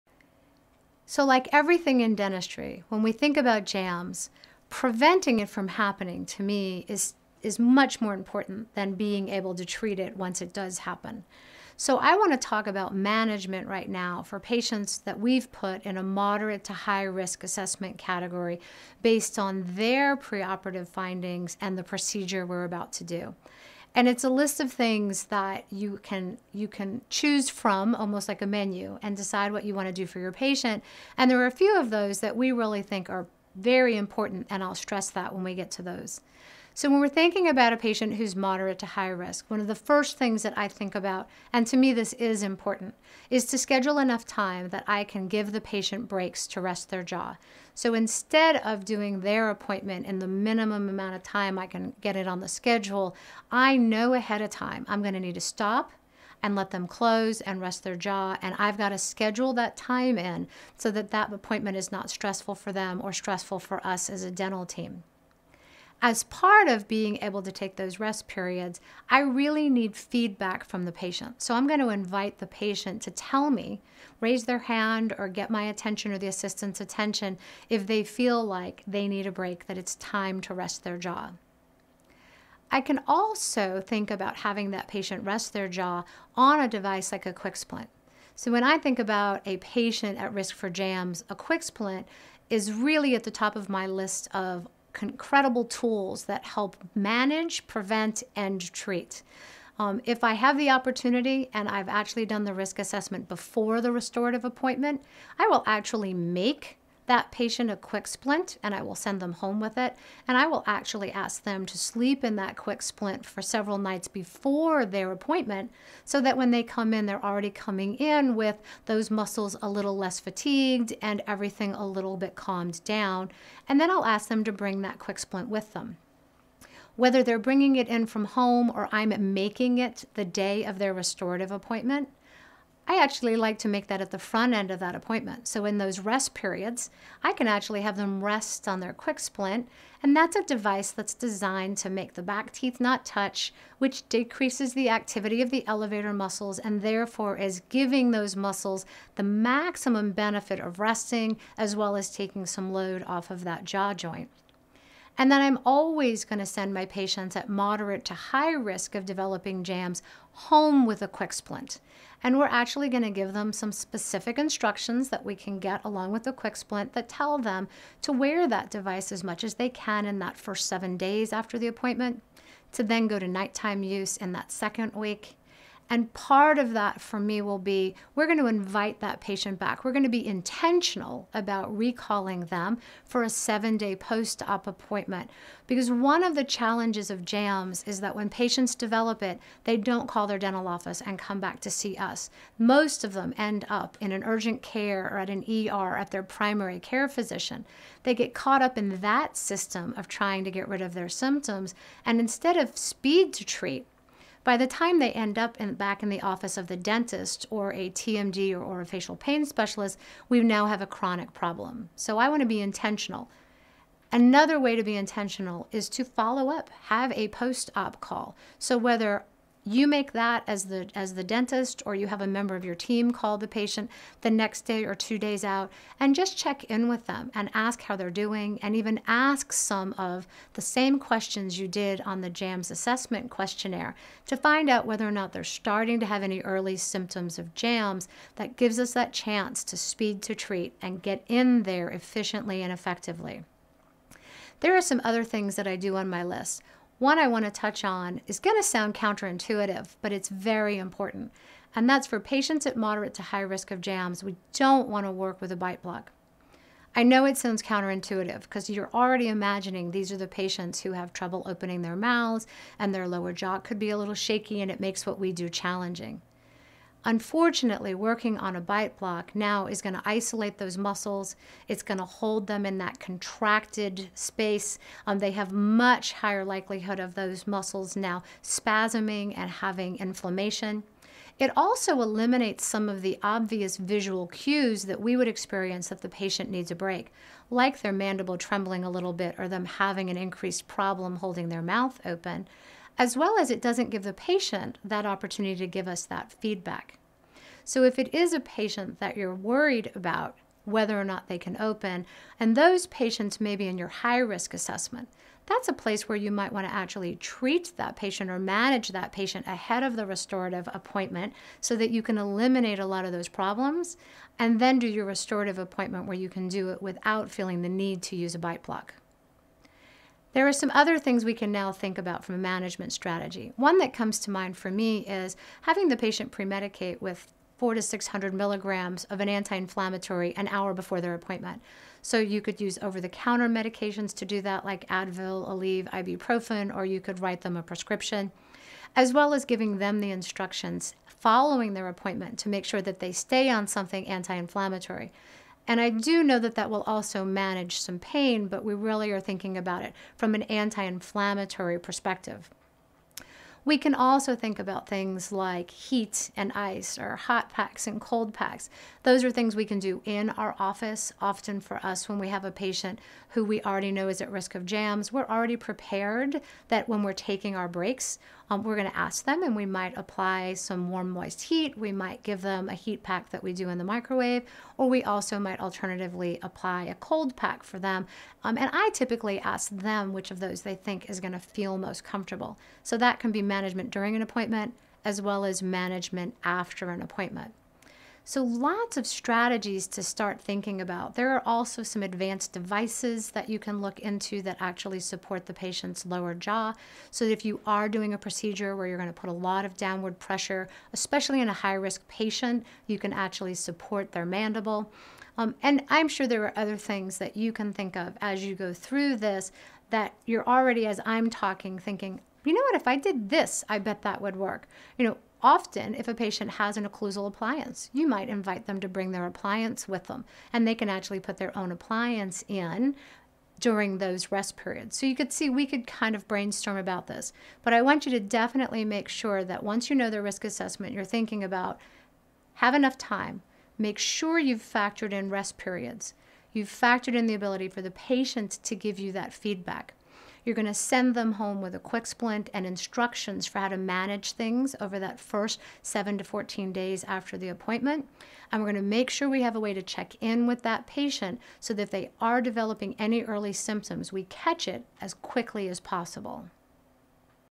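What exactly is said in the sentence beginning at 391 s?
There are also some advanced devices that you can look into that actually support the patient's lower jaw.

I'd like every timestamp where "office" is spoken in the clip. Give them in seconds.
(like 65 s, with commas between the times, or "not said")
190 s, 206 s, 360 s.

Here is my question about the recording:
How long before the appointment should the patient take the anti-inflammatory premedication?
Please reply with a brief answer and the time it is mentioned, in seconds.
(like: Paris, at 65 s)
An hour, at 330 s.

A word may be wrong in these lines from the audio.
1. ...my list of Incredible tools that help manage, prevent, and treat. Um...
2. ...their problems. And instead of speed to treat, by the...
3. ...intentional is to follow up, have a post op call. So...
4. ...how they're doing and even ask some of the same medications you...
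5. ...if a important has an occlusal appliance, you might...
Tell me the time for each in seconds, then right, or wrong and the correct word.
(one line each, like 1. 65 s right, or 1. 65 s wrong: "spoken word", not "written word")
1. 93 s right
2. 200 s wrong: "symptoms", not "problems"
3. 214 s right
4. 227 s wrong: "questions", not "medications"
5. 415 s wrong: "patient", not "important".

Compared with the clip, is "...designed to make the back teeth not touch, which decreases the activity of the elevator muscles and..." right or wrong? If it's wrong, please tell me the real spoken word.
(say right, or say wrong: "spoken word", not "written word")
right.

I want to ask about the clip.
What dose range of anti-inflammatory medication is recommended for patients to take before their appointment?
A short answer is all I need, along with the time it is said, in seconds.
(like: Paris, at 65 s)
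400 to 600 milligrams, at 327 s.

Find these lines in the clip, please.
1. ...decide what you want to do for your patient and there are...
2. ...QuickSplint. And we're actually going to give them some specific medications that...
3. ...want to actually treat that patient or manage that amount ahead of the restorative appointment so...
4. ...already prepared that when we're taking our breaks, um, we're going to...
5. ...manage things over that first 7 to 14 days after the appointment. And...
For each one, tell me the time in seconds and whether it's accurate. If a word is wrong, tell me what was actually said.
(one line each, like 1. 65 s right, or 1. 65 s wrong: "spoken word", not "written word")
1. 29 s right
2. 161 s wrong: "instructions", not "medications"
3. 306 s wrong: "patient", not "amount"
4. 365 s right
5. 443 s right.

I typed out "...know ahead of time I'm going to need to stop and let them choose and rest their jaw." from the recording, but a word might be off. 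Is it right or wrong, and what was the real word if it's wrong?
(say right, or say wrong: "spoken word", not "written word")
wrong: "close", not "choose".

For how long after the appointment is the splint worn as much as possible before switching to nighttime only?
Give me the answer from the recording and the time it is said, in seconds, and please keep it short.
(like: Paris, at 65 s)
7 days, at 170 s.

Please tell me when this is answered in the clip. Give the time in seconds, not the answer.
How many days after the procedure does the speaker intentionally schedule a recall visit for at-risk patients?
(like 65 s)
183 s.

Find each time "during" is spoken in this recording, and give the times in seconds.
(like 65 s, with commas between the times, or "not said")
383 s, 423 s.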